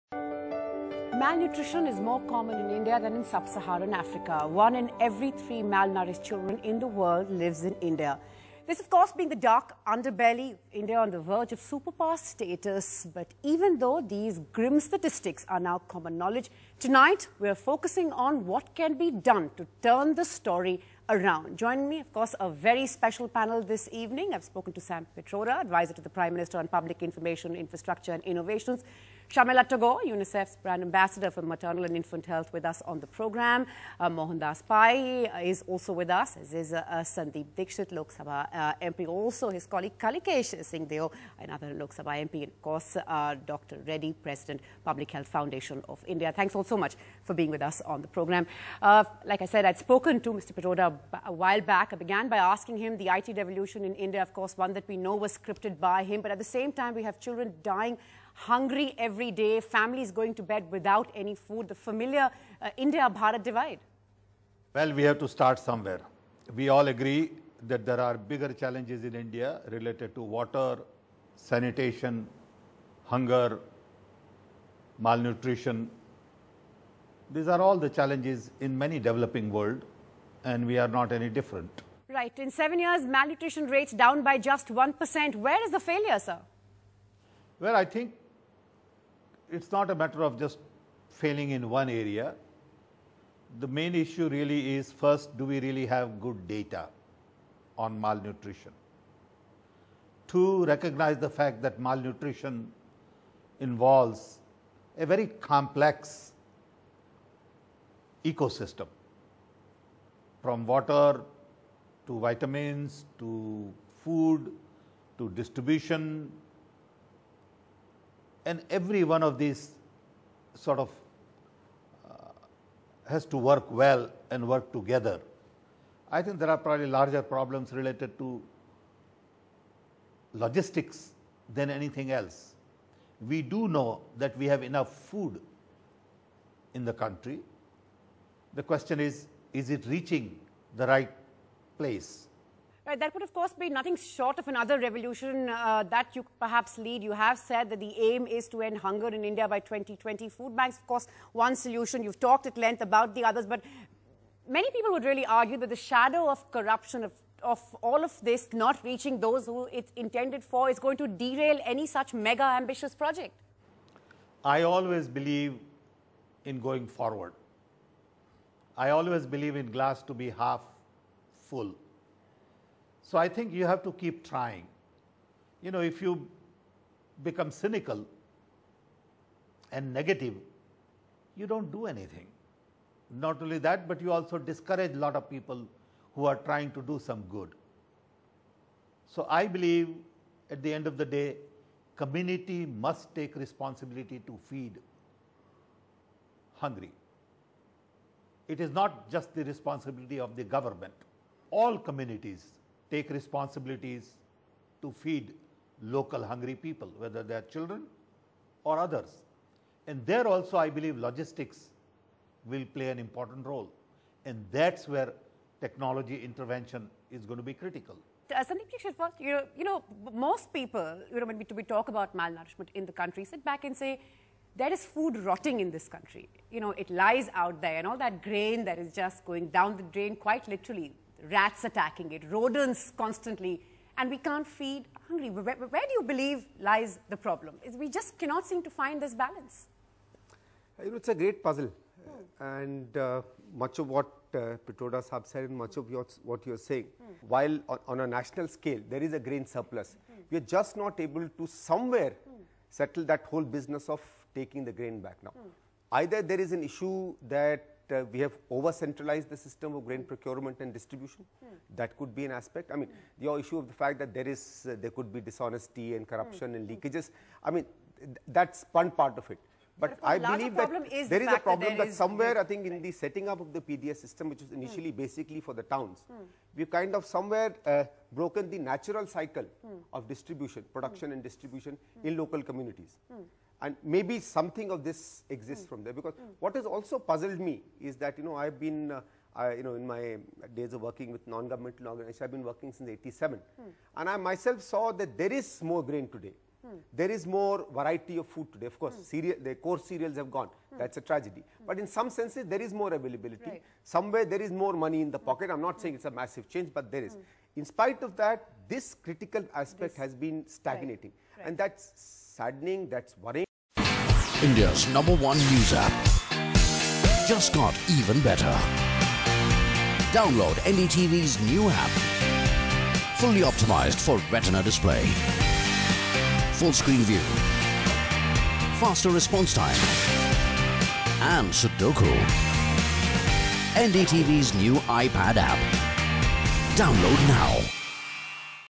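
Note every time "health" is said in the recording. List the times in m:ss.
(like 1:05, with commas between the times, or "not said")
0:32, 0:45.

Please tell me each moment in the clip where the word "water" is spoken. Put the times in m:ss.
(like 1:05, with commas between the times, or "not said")
1:10, 1:50.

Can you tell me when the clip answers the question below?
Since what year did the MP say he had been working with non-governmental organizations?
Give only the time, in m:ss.
4:52.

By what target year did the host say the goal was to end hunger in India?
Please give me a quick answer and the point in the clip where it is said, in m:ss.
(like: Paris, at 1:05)
2020, at 2:29.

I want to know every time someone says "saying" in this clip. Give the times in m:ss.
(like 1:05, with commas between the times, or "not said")
4:06, 5:05.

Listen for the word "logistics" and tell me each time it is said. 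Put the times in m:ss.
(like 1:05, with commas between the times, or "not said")
2:10, 3:30.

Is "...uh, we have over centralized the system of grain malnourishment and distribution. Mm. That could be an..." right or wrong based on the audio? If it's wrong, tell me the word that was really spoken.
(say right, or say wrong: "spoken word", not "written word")
wrong: "procurement", not "malnourishment".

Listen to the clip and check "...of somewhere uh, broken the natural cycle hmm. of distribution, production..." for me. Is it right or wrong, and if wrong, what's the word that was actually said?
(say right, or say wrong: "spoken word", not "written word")
right.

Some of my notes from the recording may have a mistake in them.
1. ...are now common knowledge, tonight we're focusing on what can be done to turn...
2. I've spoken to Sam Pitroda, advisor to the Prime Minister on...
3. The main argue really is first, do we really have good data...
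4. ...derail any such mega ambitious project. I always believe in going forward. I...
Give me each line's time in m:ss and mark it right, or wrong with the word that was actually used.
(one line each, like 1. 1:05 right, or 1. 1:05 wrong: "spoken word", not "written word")
1. 0:15 right
2. 0:24 right
3. 1:33 wrong: "issue", not "argue"
4. 2:41 right.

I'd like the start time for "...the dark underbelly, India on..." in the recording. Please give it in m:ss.
0:09.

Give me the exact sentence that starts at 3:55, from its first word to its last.
Where, where do you believe lies the problem?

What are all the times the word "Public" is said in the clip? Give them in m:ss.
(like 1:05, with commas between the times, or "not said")
0:26, 0:44.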